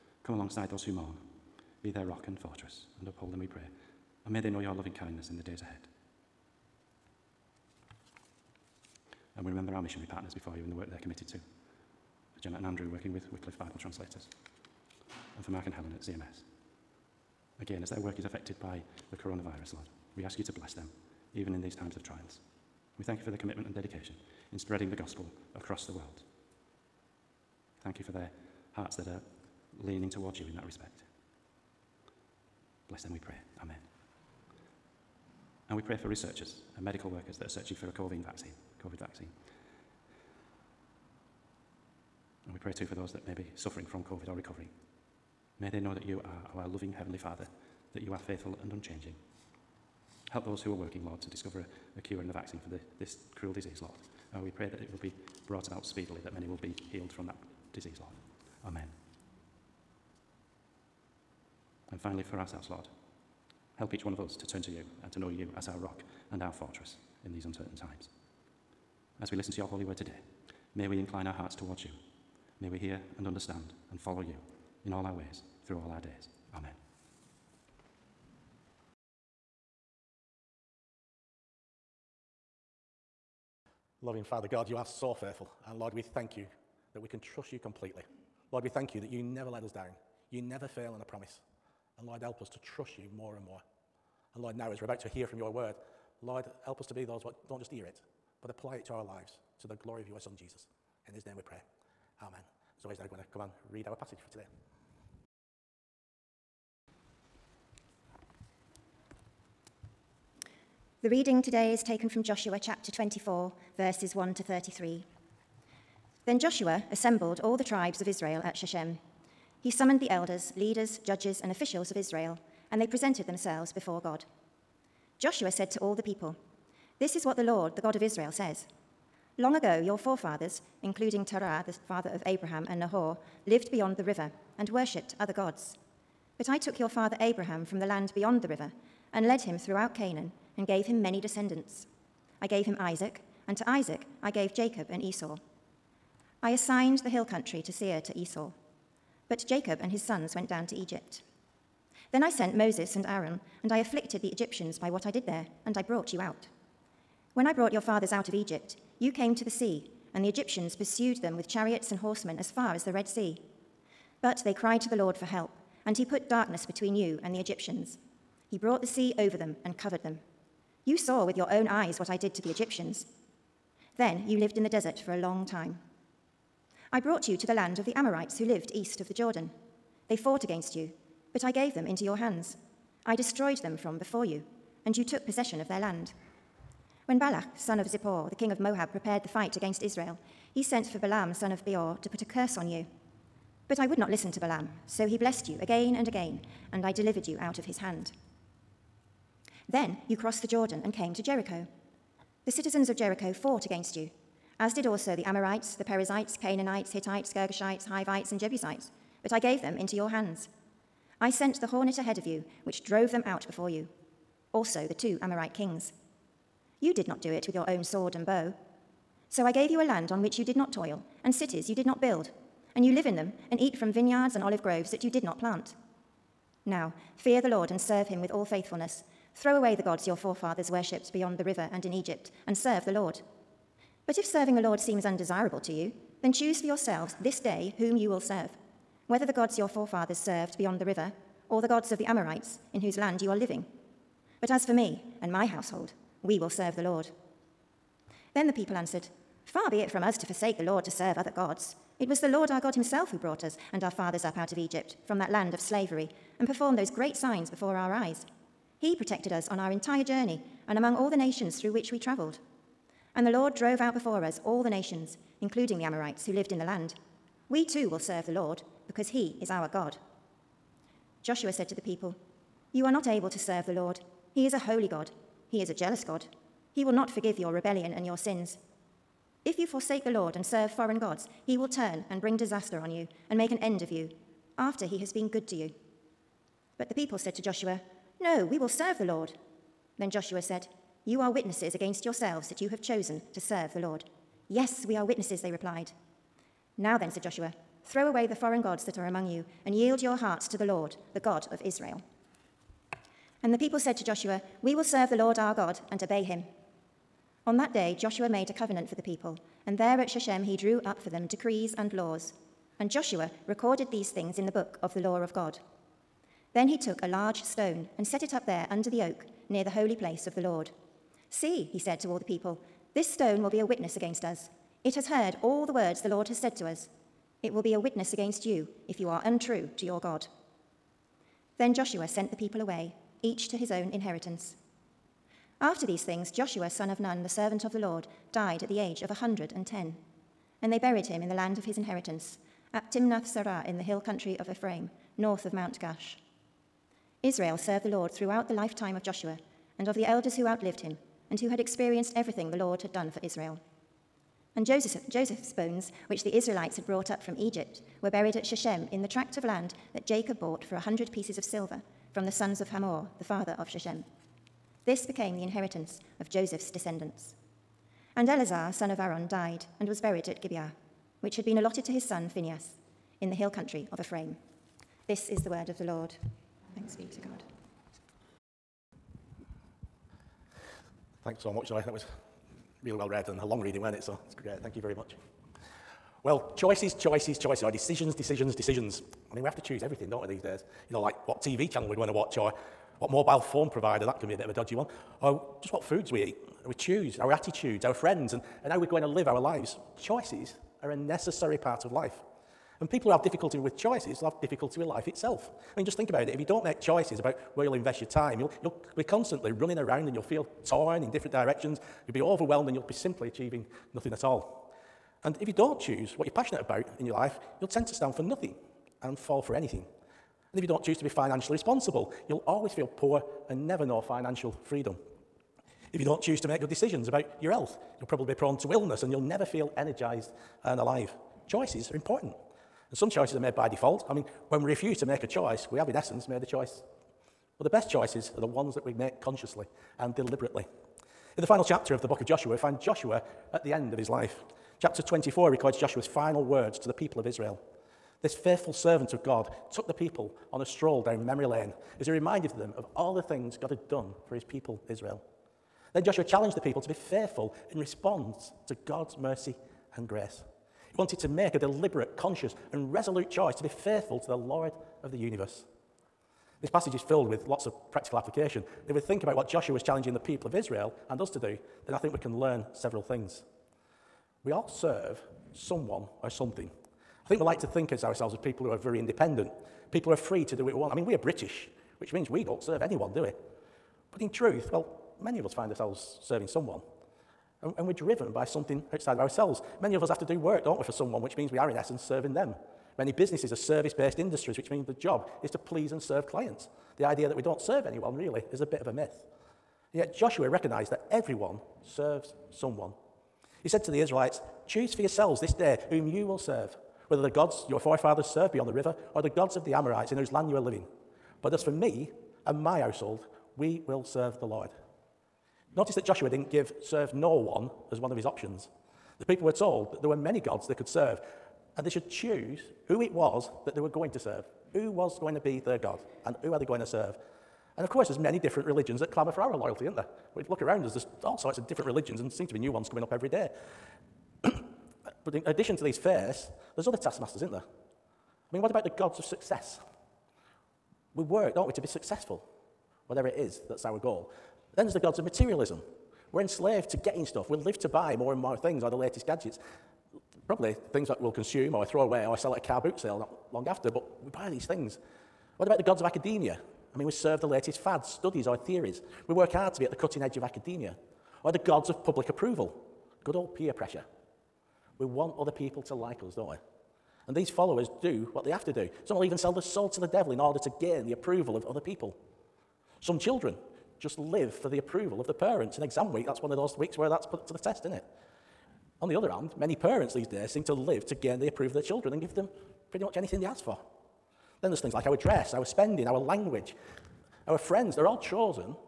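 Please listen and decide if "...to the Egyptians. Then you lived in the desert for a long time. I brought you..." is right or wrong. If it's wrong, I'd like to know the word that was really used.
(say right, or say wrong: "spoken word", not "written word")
right.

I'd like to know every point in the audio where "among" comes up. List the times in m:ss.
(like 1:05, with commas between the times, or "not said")
4:20, 4:59.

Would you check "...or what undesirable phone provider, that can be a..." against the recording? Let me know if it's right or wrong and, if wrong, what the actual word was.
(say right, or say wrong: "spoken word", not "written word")
wrong: "mobile", not "undesirable".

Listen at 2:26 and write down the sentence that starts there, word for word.
I assigned the hill country to Seir to Esau.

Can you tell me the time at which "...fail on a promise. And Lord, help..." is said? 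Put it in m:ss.
1:30.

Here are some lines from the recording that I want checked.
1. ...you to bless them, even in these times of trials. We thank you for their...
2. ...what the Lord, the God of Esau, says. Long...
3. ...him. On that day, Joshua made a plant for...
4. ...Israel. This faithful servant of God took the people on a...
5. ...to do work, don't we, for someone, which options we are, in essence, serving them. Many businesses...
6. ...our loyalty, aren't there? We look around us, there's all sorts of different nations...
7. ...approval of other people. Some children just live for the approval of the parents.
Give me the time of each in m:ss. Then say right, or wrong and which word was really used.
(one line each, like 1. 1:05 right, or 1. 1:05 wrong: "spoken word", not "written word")
1. 0:20 right
2. 2:07 wrong: "Israel", not "Esau"
3. 5:06 wrong: "covenant", not "plant"
4. 7:27 right
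5. 8:10 wrong: "means", not "options"
6. 8:49 wrong: "religions", not "nations"
7. 9:31 right.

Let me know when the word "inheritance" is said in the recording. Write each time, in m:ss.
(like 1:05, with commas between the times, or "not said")
5:33, 5:41, 6:05.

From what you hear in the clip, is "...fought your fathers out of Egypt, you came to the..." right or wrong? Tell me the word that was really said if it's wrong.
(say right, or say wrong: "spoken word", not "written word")
wrong: "brought", not "fought".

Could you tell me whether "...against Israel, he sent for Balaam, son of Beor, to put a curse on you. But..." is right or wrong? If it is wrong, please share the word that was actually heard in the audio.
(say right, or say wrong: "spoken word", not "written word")
right.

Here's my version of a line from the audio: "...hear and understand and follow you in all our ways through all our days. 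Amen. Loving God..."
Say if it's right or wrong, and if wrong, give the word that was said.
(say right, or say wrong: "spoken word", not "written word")
wrong: "Father", not "God".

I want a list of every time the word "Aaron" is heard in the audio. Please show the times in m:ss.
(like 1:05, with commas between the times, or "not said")
2:33, 6:08.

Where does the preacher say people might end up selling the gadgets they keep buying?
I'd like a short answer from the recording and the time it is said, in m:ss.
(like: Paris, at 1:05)
car boot sale, at 9:12.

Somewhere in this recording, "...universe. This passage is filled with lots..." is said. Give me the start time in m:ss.
7:45.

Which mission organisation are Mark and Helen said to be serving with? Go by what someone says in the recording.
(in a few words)
CMS.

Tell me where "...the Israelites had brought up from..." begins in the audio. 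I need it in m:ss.
5:56.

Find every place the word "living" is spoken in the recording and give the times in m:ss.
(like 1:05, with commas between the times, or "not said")
4:03, 8:30.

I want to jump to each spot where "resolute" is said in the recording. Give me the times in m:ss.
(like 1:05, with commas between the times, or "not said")
7:42.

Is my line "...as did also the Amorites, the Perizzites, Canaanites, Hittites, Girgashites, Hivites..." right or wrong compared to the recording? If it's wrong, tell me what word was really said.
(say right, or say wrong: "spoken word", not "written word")
right.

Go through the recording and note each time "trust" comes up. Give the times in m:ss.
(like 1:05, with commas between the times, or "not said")
1:27, 1:32.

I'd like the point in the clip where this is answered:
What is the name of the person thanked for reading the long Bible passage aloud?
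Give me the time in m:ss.
6:21.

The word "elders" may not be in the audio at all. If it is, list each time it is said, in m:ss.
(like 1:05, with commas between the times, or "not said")
2:00, 5:50.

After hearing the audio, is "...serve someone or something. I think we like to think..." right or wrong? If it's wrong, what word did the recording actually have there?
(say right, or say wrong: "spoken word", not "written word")
right.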